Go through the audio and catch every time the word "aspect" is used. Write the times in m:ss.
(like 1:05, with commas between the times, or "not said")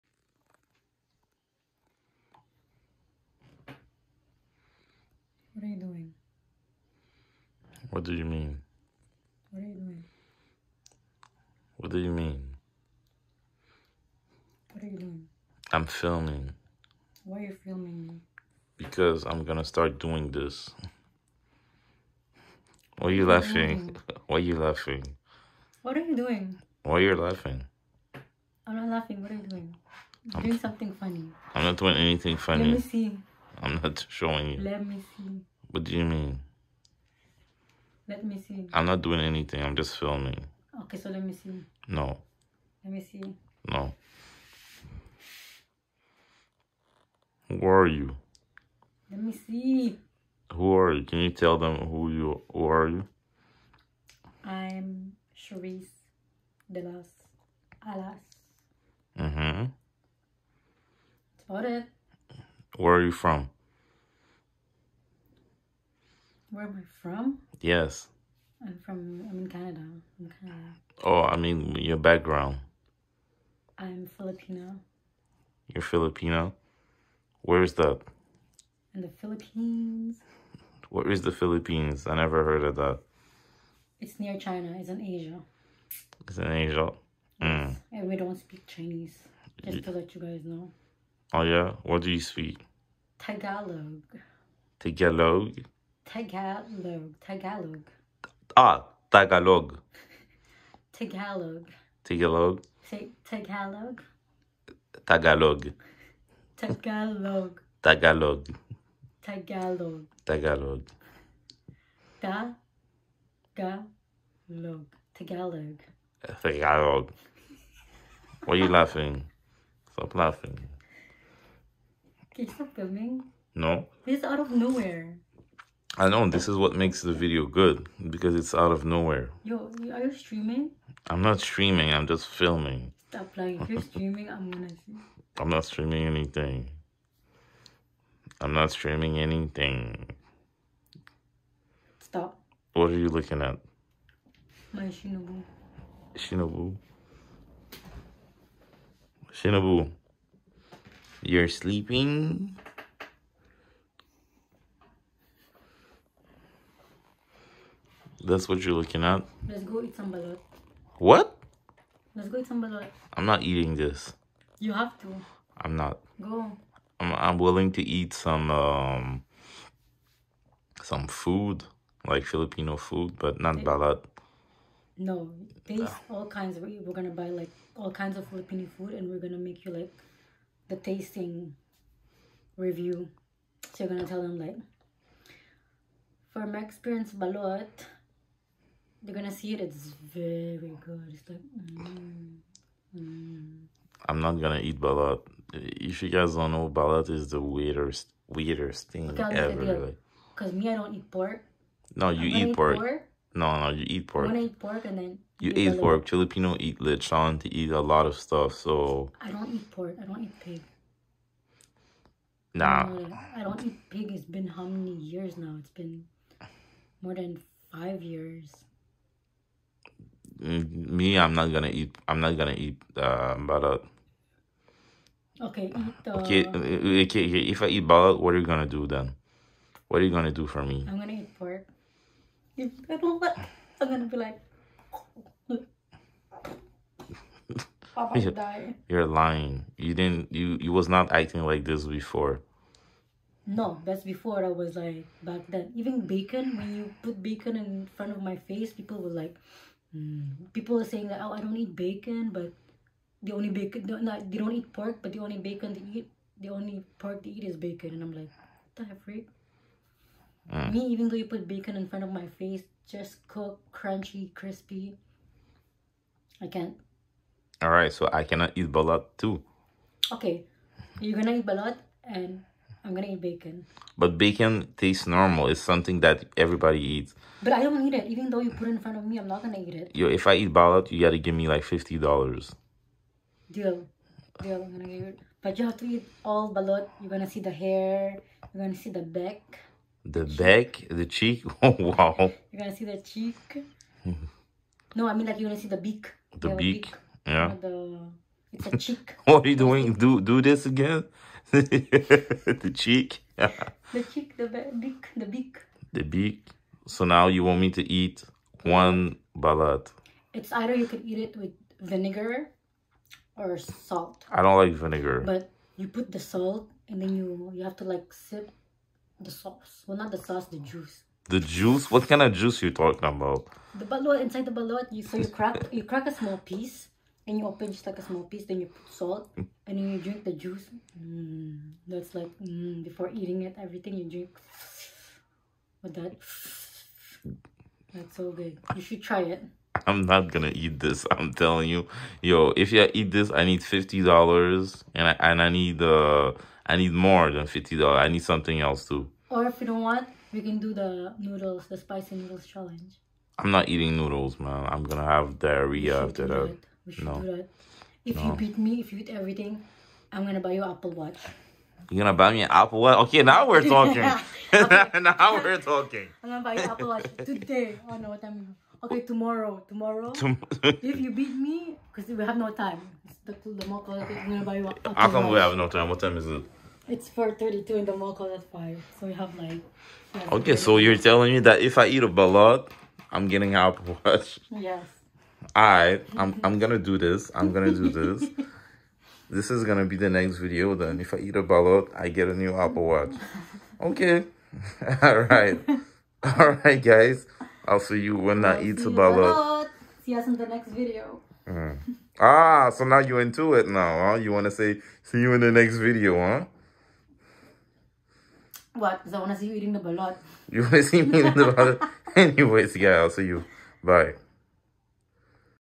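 not said.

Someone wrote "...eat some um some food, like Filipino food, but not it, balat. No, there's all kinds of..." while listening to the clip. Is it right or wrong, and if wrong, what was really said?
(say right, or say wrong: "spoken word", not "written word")
right.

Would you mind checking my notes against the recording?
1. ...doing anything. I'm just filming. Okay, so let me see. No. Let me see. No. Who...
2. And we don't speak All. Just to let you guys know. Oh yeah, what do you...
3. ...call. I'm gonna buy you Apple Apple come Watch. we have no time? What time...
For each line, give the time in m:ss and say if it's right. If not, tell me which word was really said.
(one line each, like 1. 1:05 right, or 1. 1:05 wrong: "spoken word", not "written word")
1. 0:39 right
2. 1:27 wrong: "Chinese", not "All"
3. 6:13 wrong: "How", not "Apple".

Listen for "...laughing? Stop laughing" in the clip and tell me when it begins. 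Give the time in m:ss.
1:58.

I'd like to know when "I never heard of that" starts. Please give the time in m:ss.
1:22.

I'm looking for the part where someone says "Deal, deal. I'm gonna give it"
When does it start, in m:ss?
4:43.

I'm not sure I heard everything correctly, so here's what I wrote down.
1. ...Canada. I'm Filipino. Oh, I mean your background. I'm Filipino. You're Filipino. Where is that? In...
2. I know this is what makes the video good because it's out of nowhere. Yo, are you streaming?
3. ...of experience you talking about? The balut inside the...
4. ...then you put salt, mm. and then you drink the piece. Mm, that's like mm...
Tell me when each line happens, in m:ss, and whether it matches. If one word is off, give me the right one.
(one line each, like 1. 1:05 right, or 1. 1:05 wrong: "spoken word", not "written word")
1. 1:09 wrong: "Canada", not "Filipino"
2. 2:05 right
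3. 5:22 wrong: "juice", not "experience"
4. 5:28 wrong: "juice", not "piece".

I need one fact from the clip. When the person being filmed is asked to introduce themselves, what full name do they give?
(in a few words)
Charisse de las Alas.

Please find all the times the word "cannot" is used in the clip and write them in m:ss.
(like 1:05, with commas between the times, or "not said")
4:28.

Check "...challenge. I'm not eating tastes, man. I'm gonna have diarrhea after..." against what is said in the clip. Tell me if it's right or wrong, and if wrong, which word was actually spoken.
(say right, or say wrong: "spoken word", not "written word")
wrong: "noodles", not "tastes".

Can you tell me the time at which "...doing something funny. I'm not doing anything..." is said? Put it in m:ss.
0:30.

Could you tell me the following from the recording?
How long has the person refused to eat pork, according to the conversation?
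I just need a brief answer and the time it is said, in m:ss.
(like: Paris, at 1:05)
More than five years, at 3:37.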